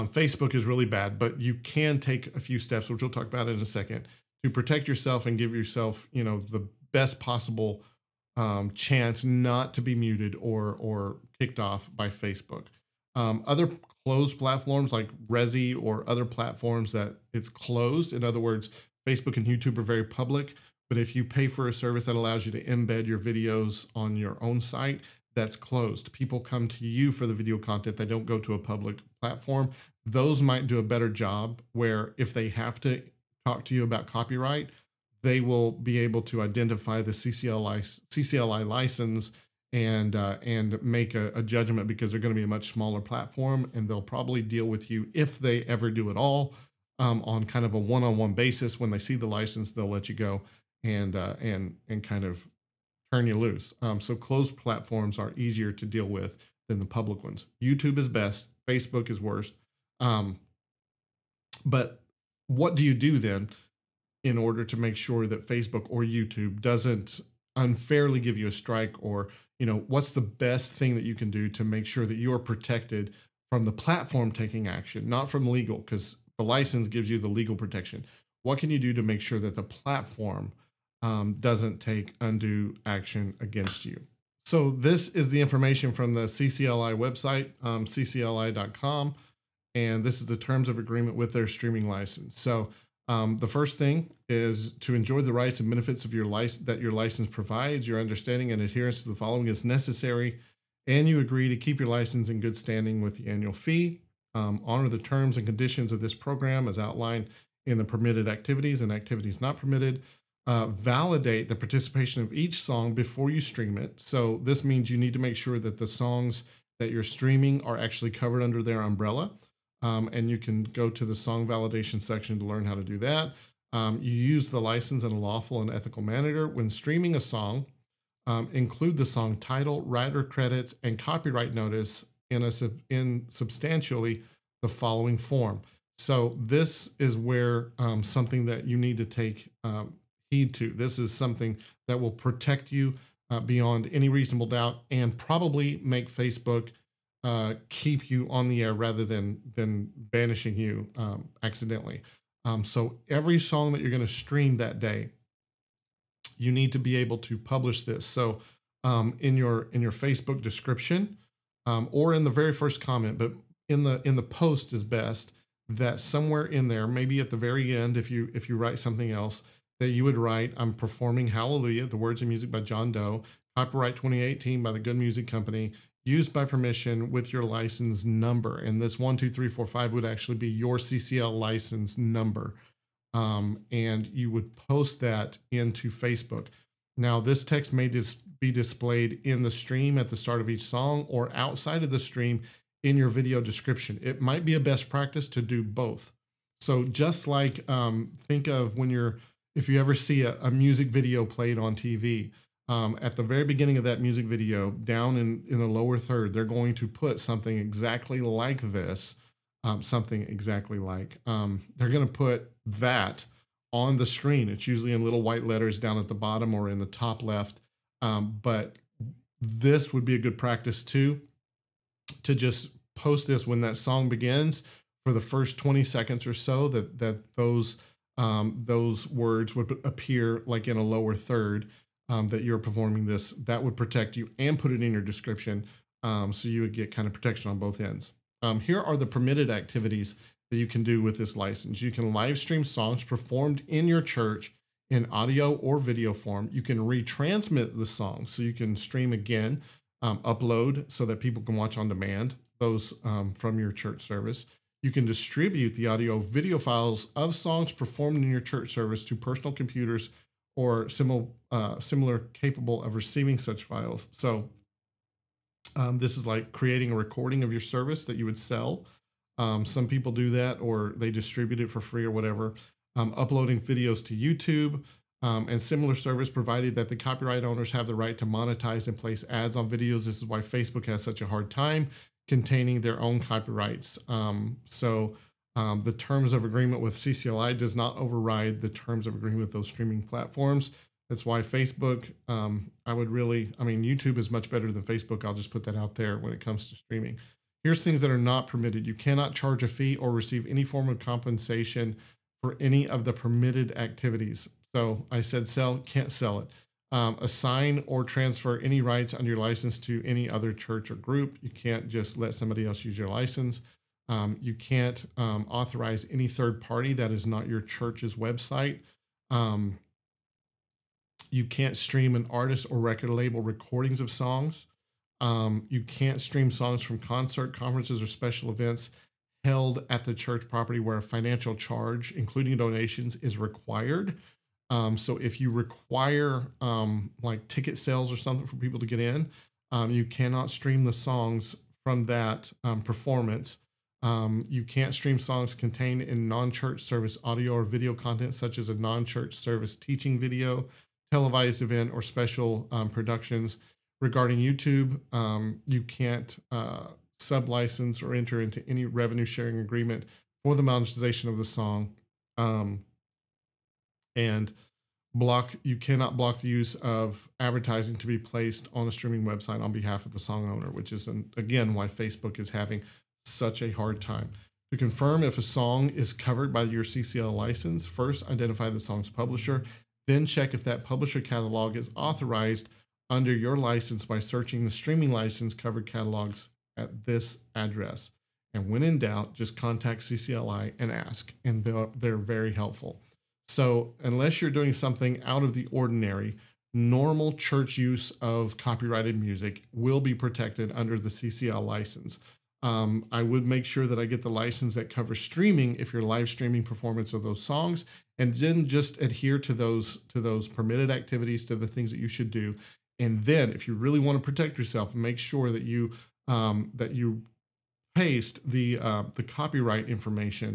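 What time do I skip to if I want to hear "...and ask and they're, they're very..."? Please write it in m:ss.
6:30.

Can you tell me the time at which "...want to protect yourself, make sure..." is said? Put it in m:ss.
6:53.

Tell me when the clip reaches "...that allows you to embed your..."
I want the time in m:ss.
0:22.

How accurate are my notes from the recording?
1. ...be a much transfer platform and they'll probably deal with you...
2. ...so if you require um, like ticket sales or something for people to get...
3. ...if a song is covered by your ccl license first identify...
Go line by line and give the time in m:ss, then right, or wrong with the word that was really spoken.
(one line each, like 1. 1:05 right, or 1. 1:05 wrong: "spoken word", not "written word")
1. 0:42 wrong: "smaller", not "transfer"
2. 5:34 right
3. 6:15 right.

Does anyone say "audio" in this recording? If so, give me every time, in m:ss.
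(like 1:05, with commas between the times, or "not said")
4:05, 4:15, 5:47.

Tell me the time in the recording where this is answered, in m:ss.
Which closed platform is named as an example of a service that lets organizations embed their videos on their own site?
0:15.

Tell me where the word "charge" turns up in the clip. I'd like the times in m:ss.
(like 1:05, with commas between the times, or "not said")
4:59, 5:31.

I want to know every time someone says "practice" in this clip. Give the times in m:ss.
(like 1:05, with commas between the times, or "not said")
3:14, 3:40.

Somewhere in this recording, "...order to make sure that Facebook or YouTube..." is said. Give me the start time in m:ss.
1:04.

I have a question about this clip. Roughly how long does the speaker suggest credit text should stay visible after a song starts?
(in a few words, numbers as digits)
20 seconds.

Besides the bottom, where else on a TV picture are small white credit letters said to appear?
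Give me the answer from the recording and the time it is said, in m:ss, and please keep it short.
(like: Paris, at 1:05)
Top left, at 3:36.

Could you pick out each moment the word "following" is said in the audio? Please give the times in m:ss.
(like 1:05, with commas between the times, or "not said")
1:39, 2:14.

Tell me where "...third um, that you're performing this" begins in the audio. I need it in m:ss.
3:51.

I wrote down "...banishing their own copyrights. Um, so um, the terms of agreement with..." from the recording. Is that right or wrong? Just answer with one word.
wrong.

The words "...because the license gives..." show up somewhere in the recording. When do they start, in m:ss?
1:15.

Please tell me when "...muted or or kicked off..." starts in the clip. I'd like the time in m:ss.
0:09.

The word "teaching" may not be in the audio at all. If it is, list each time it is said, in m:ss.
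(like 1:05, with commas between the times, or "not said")
5:49.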